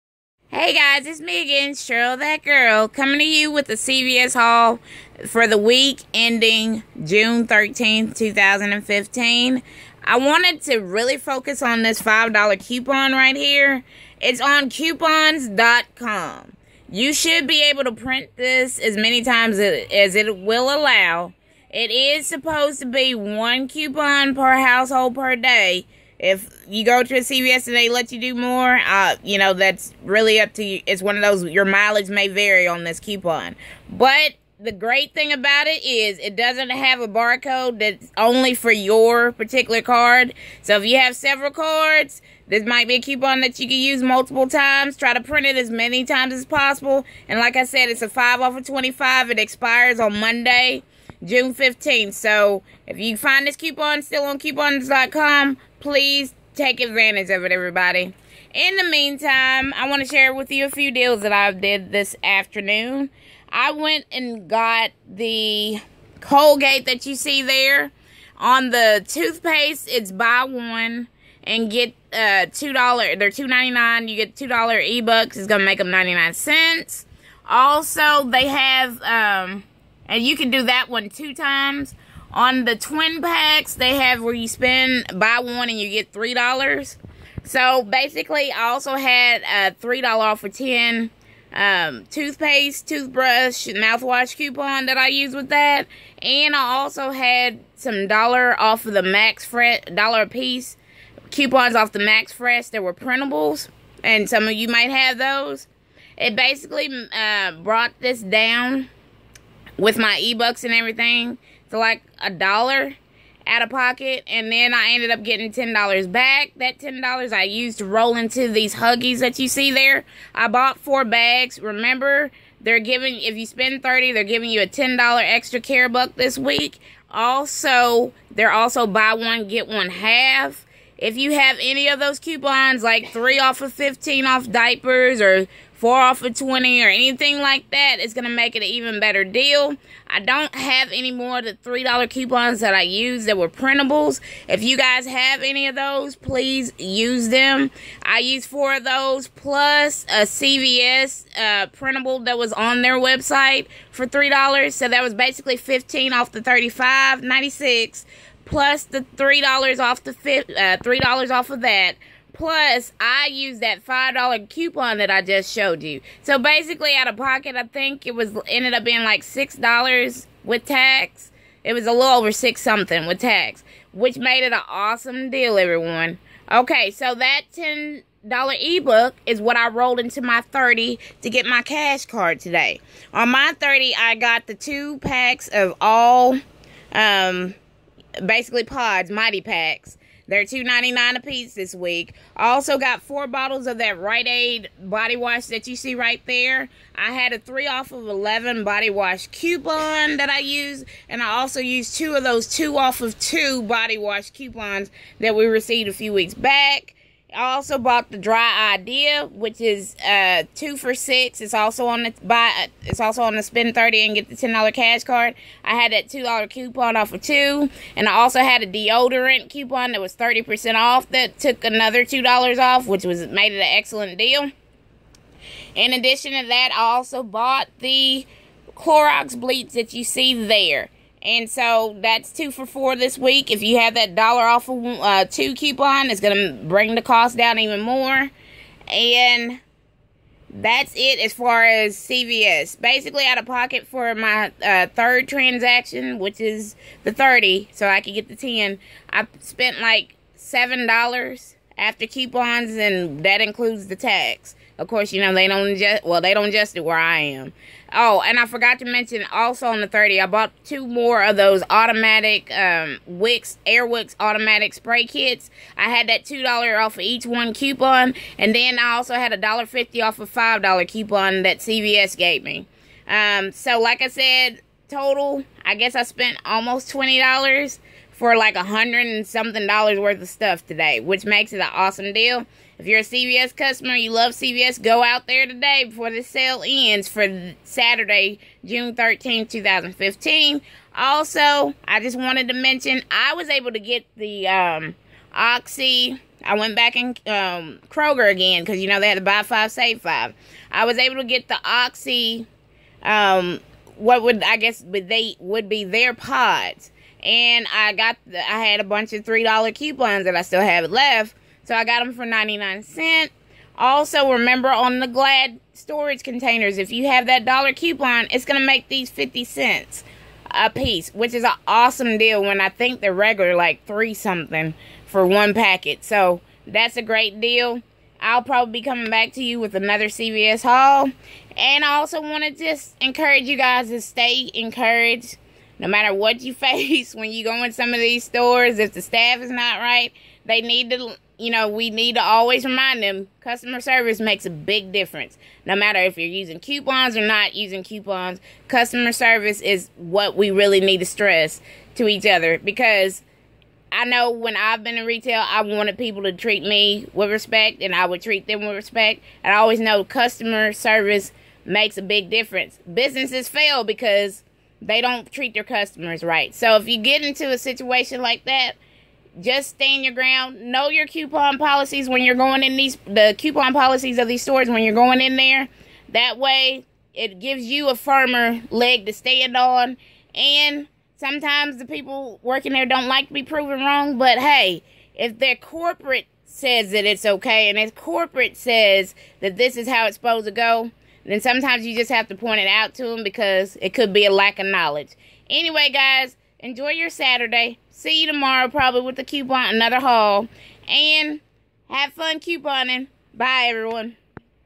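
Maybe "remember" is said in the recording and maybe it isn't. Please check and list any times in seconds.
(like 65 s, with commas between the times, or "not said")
121 s, 314 s.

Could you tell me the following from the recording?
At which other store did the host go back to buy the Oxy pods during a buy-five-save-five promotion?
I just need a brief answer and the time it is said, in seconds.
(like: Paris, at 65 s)
Kroger, at 297 s.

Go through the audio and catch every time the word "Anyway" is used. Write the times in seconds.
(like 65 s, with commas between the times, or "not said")
395 s.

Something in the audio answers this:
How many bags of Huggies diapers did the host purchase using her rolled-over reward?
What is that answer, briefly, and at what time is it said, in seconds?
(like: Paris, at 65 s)
4, at 120 s.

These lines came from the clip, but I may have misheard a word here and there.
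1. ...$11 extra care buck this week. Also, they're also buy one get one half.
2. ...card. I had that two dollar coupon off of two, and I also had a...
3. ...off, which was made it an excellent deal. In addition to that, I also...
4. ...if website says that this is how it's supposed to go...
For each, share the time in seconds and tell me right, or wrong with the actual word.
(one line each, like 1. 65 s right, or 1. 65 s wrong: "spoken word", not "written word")
1. 124 s wrong: "10", not "11"
2. 215 s right
3. 222 s right
4. 387 s wrong: "corporate", not "website".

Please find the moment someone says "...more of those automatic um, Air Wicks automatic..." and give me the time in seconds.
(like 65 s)
260 s.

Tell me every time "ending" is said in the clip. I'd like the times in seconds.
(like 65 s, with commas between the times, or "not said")
6 s.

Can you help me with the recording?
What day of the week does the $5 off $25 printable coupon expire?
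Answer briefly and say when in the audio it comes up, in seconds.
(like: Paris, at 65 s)
Monday, at 50 s.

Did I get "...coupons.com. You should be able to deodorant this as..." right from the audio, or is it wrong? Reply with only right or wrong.
wrong.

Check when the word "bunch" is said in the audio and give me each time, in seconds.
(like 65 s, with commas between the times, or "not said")
308 s.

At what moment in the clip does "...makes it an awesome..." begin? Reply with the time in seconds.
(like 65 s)
281 s.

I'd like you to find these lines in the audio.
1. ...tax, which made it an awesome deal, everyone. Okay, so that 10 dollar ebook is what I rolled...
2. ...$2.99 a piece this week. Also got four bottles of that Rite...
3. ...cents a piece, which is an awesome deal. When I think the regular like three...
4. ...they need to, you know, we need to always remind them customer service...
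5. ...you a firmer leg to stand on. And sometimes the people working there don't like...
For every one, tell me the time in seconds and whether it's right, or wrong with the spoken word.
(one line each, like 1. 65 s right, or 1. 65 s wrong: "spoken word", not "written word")
1. 173 s right
2. 190 s right
3. 319 s right
4. 340 s right
5. 377 s right.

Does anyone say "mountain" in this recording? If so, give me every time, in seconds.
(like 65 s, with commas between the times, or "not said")
not said.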